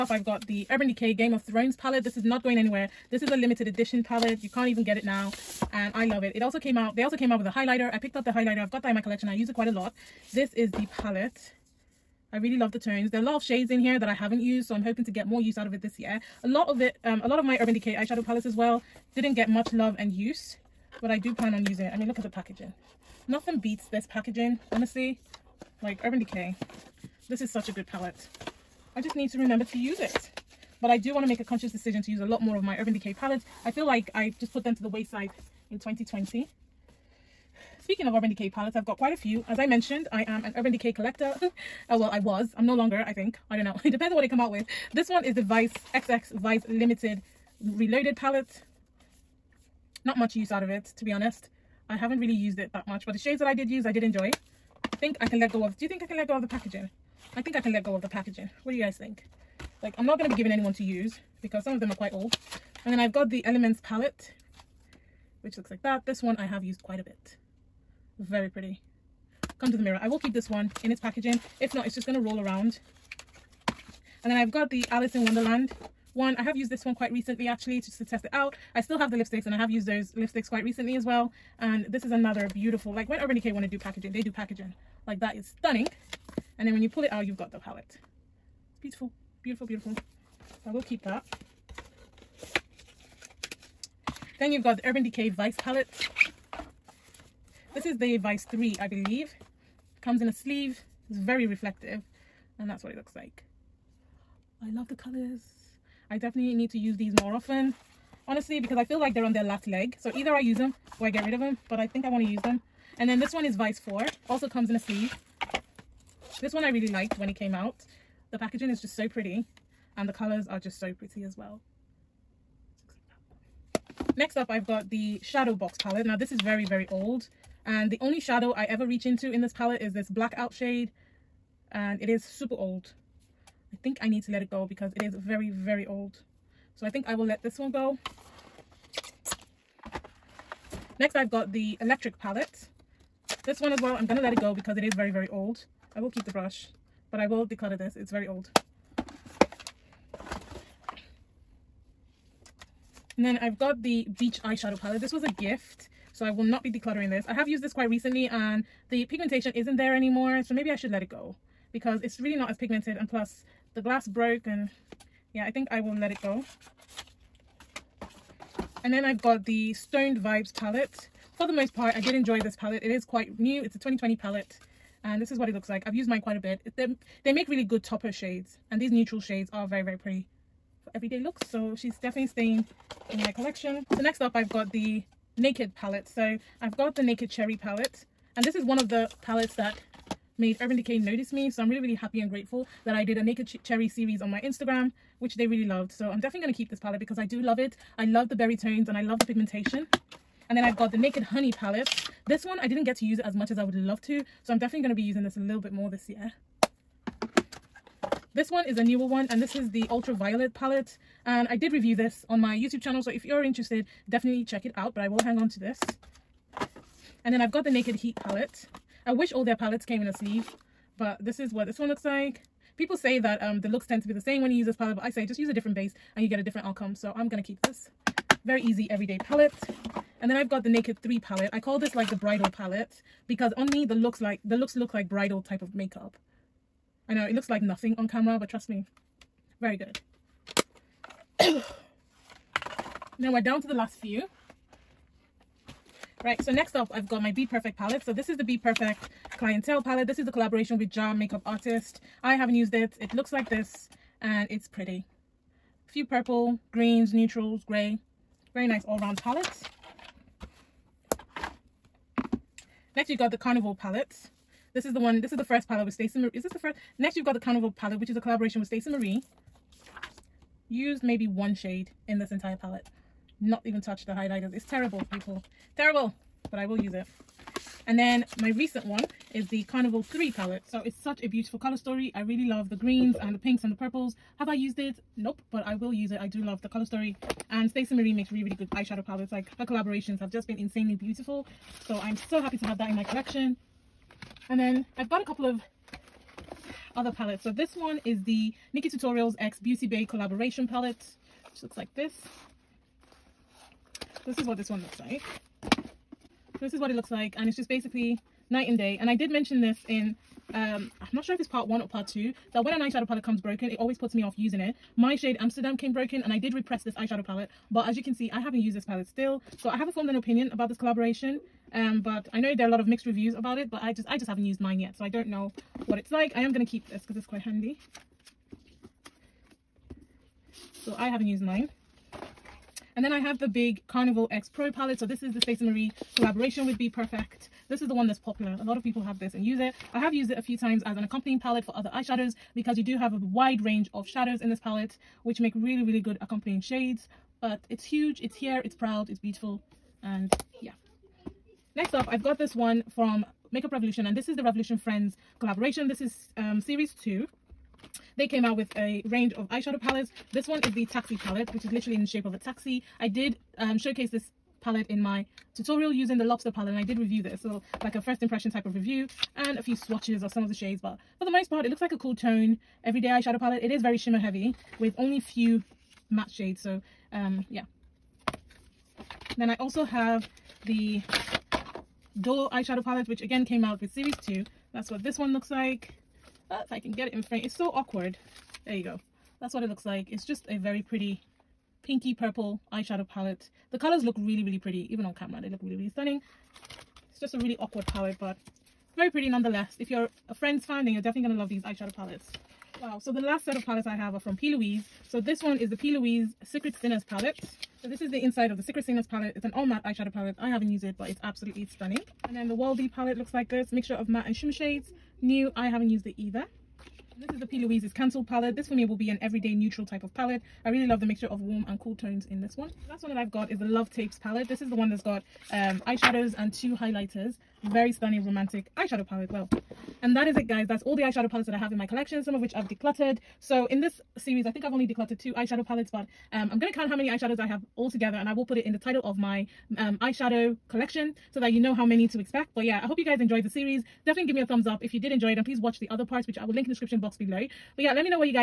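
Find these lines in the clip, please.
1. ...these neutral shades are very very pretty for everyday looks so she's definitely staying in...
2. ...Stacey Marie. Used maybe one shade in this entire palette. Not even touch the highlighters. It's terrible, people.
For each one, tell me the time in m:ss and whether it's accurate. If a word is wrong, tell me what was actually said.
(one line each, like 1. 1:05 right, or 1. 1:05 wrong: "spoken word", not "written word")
1. 2:58 right
2. 4:28 right.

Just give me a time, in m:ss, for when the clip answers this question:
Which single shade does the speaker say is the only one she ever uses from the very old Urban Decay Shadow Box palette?
2:10.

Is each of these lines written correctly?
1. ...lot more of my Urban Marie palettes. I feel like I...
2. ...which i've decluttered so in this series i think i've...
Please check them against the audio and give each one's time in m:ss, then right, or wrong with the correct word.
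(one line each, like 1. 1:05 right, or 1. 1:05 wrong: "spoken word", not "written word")
1. 0:32 wrong: "Decay", not "Marie"
2. 7:12 right.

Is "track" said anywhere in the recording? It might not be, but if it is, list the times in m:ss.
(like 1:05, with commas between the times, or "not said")
not said.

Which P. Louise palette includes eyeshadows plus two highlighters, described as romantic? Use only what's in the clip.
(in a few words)
Love Tapes.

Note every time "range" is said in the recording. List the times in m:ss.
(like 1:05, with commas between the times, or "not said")
5:43, 5:59.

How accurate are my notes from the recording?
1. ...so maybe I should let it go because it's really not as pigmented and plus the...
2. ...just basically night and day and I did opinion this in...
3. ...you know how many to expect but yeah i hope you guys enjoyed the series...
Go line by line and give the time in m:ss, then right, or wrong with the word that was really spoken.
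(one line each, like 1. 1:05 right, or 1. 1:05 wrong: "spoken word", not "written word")
1. 2:40 right
2. 5:07 wrong: "mention", not "opinion"
3. 7:21 right.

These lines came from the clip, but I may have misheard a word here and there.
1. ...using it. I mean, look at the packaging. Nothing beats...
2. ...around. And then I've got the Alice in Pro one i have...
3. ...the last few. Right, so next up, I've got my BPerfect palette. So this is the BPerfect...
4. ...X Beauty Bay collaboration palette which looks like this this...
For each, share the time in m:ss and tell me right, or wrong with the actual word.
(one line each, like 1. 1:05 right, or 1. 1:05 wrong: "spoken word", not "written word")
1. 0:21 right
2. 1:12 wrong: "Wonderland", not "Pro"
3. 4:03 right
4. 4:59 right.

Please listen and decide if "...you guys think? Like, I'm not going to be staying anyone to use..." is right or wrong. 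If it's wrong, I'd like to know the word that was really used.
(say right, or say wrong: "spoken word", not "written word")
wrong: "giving", not "staying".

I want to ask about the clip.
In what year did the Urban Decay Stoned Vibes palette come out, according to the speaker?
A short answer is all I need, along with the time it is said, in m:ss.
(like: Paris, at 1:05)
2020, at 2:53.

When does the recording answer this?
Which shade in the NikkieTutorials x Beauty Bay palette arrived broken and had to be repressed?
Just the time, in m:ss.
5:15.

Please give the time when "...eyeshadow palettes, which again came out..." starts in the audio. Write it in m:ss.
6:22.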